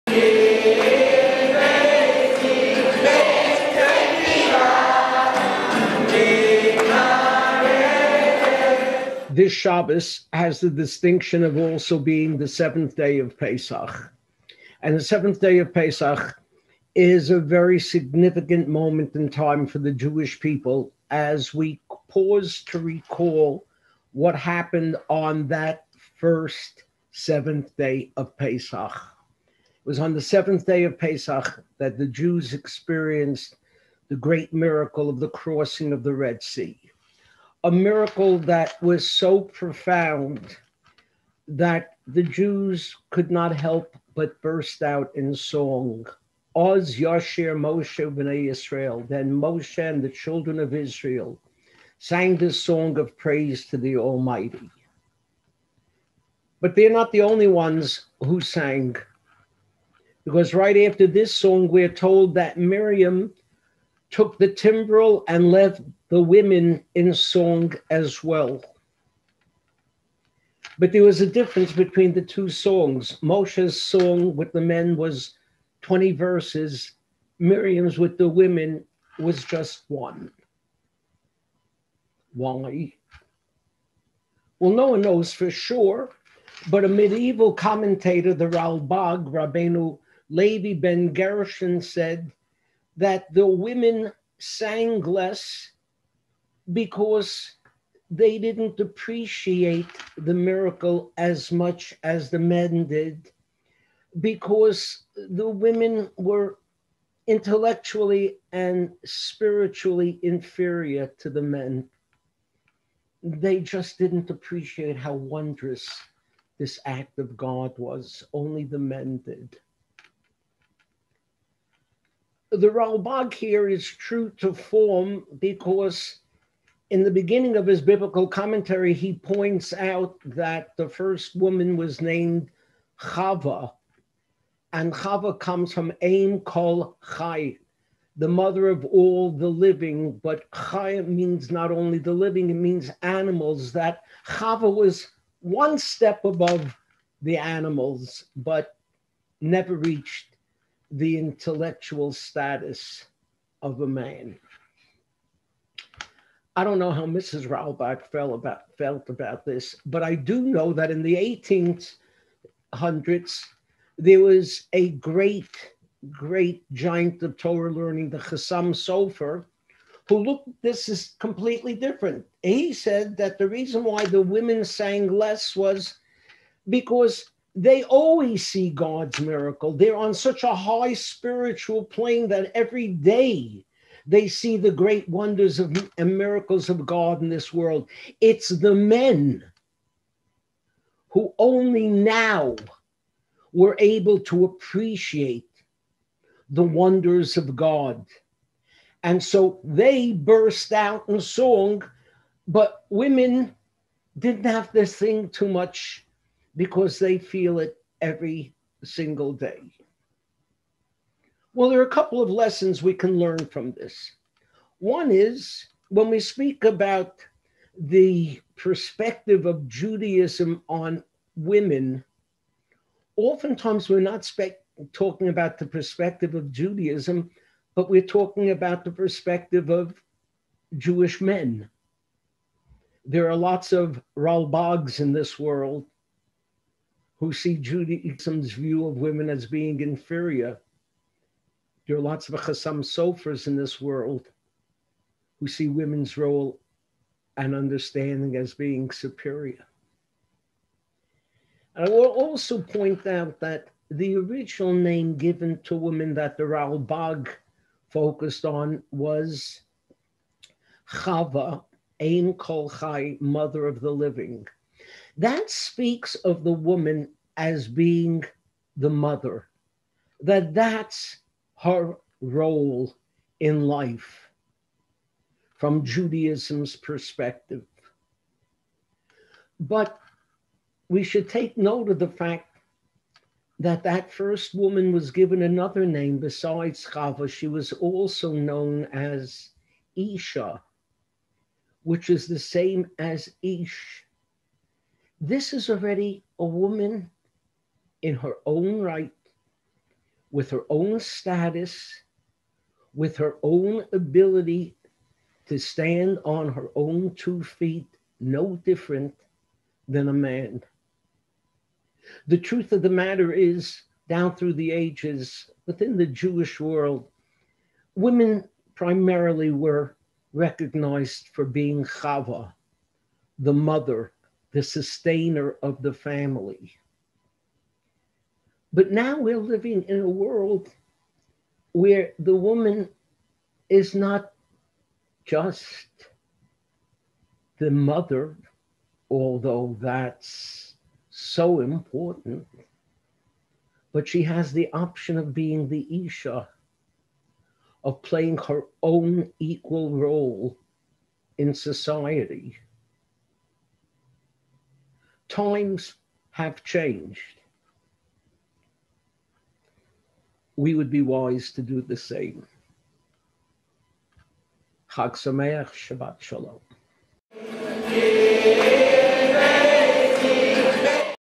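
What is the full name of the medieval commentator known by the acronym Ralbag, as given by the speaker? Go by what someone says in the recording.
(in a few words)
Rabbeinu Levi ben Gershon.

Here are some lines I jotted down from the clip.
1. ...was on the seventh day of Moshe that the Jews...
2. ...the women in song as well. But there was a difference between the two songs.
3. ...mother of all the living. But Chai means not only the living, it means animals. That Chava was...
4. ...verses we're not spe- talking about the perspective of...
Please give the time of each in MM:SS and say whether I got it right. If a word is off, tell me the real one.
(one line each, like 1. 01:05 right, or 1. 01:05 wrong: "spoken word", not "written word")
1. 00:29 wrong: "Pesach", not "Moshe"
2. 01:06 right
3. 02:18 right
4. 03:43 wrong: "oftentimes", not "verses".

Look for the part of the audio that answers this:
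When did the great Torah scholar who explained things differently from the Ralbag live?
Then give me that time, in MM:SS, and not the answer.
02:42.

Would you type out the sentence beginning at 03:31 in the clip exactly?
Well, there are a couple of lessons we can learn from this.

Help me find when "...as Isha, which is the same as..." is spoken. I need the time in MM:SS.
04:48.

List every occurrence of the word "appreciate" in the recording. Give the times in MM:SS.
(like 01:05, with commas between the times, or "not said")
01:38, 01:54, 03:14.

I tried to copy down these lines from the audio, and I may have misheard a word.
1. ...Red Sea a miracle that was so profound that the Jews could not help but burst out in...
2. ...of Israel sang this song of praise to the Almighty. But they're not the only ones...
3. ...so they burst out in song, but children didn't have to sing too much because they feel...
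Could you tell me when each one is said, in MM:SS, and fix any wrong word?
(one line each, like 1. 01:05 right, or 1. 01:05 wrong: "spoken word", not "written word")
1. 00:36 right
2. 00:50 right
3. 03:19 wrong: "women", not "children".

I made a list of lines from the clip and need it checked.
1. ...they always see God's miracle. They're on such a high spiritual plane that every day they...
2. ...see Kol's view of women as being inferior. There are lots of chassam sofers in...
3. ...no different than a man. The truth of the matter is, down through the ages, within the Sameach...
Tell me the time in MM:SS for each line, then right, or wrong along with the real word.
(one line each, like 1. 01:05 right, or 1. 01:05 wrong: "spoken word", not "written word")
1. 02:57 right
2. 03:57 wrong: "Judaism", not "Kol"
3. 05:08 wrong: "Jewish", not "Sameach".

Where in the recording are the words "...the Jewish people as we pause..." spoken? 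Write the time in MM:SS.
00:19.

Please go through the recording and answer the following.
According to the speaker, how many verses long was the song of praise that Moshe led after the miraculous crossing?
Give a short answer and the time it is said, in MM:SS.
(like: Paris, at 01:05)
20, at 01:15.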